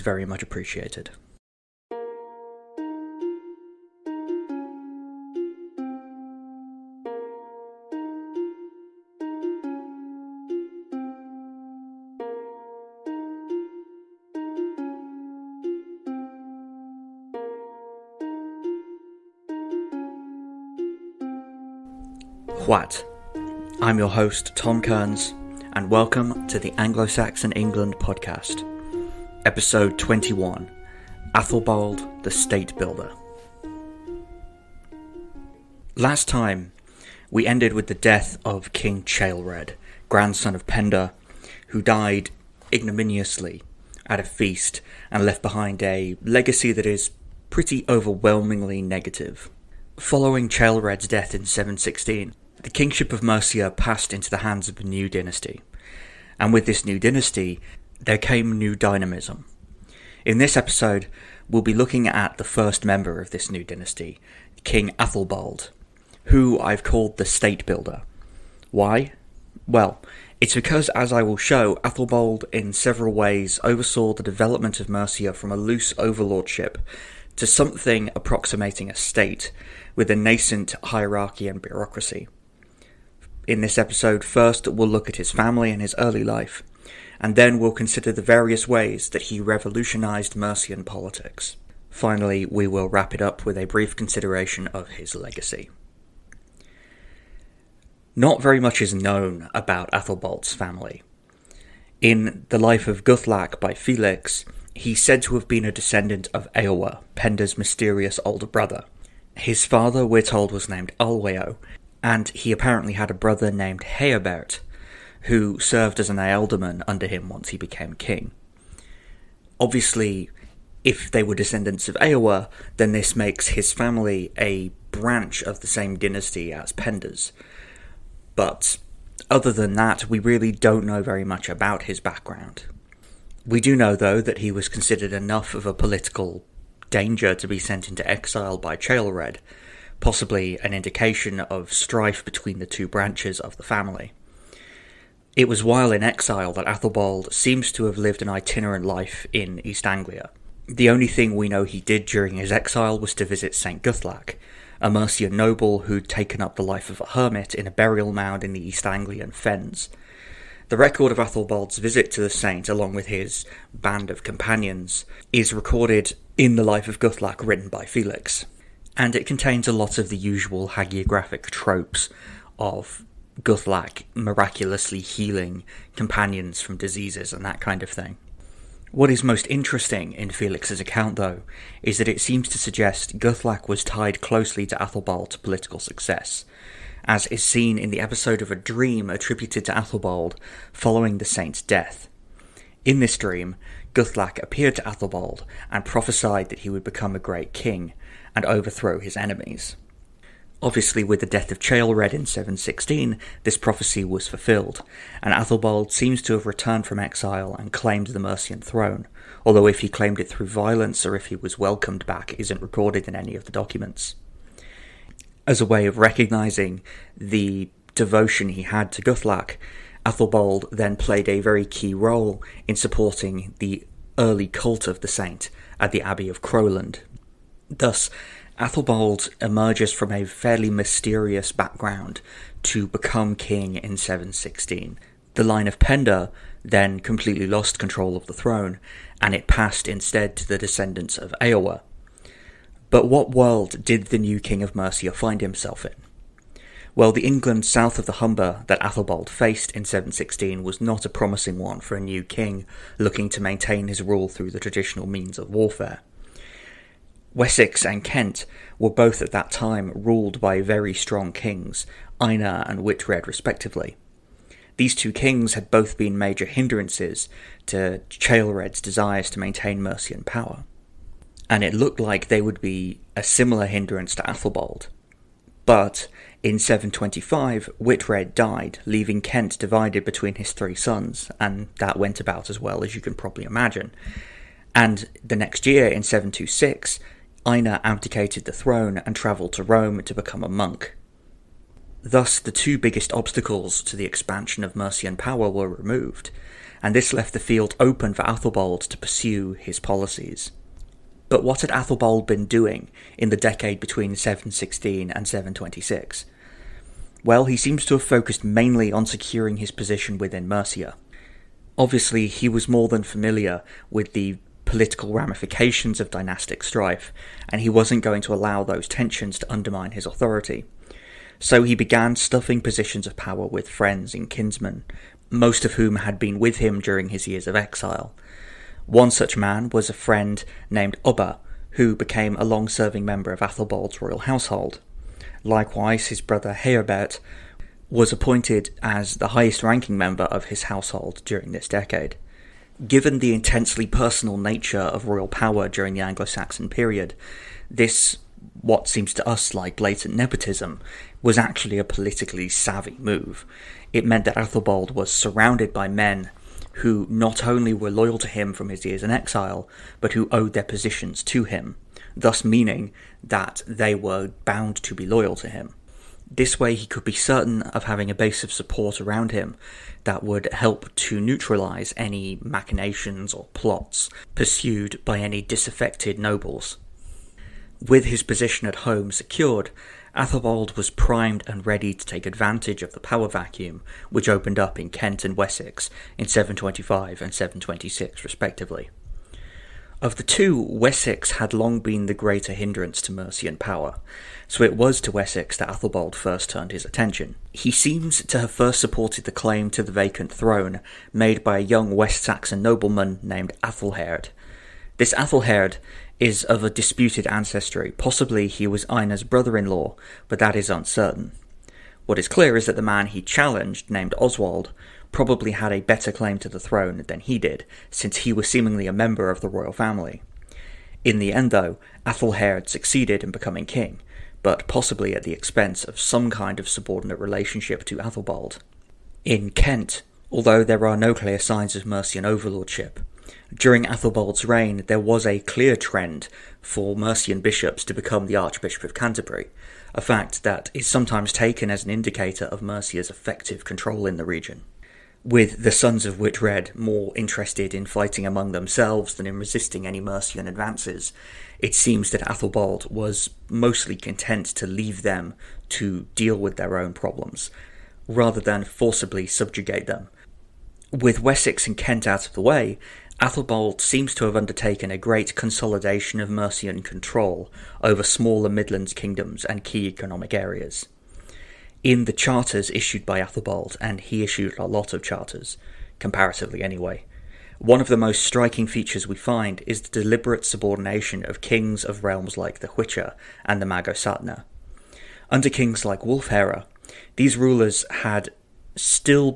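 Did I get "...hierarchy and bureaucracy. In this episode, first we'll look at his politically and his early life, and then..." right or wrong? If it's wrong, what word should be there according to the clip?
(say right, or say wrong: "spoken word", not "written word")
wrong: "family", not "politically".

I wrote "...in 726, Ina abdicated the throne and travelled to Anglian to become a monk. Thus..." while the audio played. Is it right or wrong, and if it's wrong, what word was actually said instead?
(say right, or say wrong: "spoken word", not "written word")
wrong: "Rome", not "Anglian".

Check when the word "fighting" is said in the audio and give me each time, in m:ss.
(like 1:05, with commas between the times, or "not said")
7:27.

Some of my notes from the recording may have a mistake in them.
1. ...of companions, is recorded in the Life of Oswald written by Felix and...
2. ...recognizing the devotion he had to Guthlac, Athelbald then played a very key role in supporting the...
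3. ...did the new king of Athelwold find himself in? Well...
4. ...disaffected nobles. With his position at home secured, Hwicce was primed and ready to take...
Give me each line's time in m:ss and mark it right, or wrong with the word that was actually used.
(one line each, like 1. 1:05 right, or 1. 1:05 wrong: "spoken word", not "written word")
1. 2:44 wrong: "Guthlac", not "Oswald"
2. 3:35 right
3. 4:03 wrong: "Mercia", not "Athelwold"
4. 6:15 wrong: "Athelwold", not "Hwicce".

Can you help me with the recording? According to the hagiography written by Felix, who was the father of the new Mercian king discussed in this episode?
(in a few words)
Alweo.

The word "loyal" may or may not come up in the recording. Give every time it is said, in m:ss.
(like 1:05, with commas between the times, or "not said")
5:57, 6:05.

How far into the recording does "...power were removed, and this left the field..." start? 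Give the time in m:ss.
4:55.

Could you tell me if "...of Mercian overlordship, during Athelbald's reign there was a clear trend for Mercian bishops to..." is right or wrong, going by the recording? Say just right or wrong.
right.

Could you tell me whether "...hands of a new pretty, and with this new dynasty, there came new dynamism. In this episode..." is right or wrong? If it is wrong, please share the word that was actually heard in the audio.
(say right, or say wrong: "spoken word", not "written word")
wrong: "dynasty", not "pretty".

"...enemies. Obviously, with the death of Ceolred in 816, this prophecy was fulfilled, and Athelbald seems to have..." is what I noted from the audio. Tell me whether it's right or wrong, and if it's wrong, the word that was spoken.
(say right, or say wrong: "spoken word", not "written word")
wrong: "716", not "816".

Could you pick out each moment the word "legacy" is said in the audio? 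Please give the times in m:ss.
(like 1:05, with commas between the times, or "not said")
0:46, 1:35.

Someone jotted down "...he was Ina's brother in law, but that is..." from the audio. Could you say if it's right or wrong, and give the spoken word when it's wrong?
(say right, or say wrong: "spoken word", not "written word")
right.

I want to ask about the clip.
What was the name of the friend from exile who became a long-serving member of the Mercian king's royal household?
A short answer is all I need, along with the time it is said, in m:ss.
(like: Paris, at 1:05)
Ubba, at 5:31.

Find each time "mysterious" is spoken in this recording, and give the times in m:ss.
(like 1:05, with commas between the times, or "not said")
1:47, 3:50.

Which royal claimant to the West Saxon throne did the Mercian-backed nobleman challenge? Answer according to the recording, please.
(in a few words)
Oswald.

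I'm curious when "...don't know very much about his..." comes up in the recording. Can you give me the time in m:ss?
2:10.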